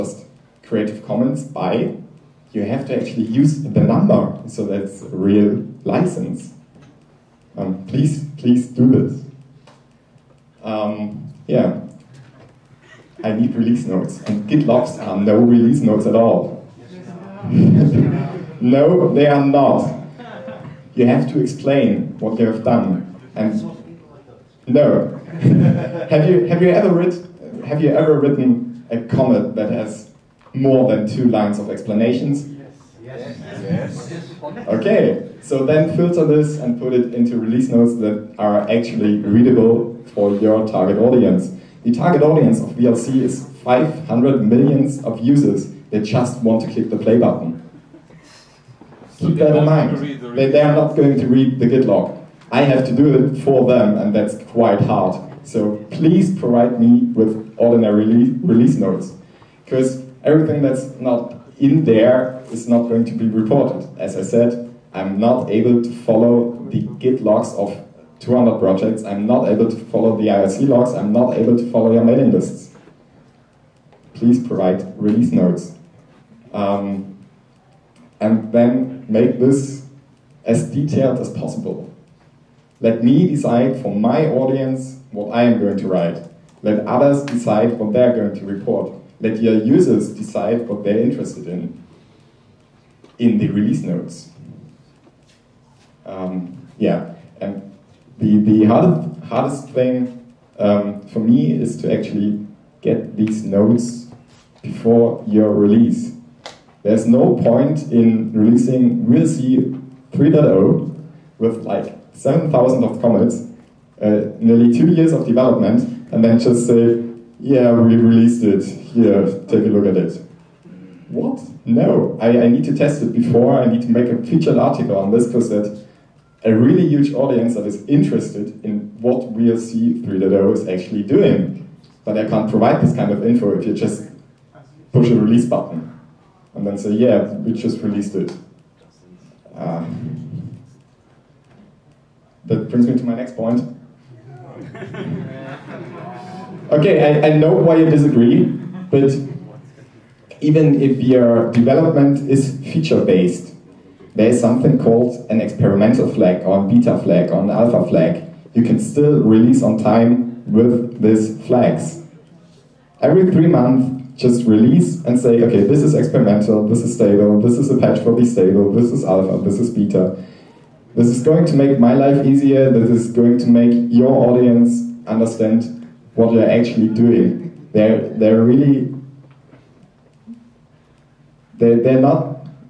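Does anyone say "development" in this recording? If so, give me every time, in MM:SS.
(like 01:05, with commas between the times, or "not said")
01:55, 02:31.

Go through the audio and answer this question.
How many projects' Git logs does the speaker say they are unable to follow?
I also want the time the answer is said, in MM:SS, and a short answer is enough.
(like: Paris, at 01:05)
200, at 01:08.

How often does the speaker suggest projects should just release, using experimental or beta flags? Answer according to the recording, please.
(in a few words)
Every three months.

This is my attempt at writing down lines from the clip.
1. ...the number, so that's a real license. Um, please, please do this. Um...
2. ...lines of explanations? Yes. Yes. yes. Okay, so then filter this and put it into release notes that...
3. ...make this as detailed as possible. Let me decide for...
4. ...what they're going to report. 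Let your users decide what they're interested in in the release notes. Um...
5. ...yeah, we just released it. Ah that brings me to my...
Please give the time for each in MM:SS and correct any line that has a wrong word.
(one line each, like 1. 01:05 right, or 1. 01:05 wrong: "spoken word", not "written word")
1. 00:03 right
2. 00:31 right
3. 01:19 right
4. 01:27 right
5. 02:16 right.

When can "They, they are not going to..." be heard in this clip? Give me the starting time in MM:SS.
00:50.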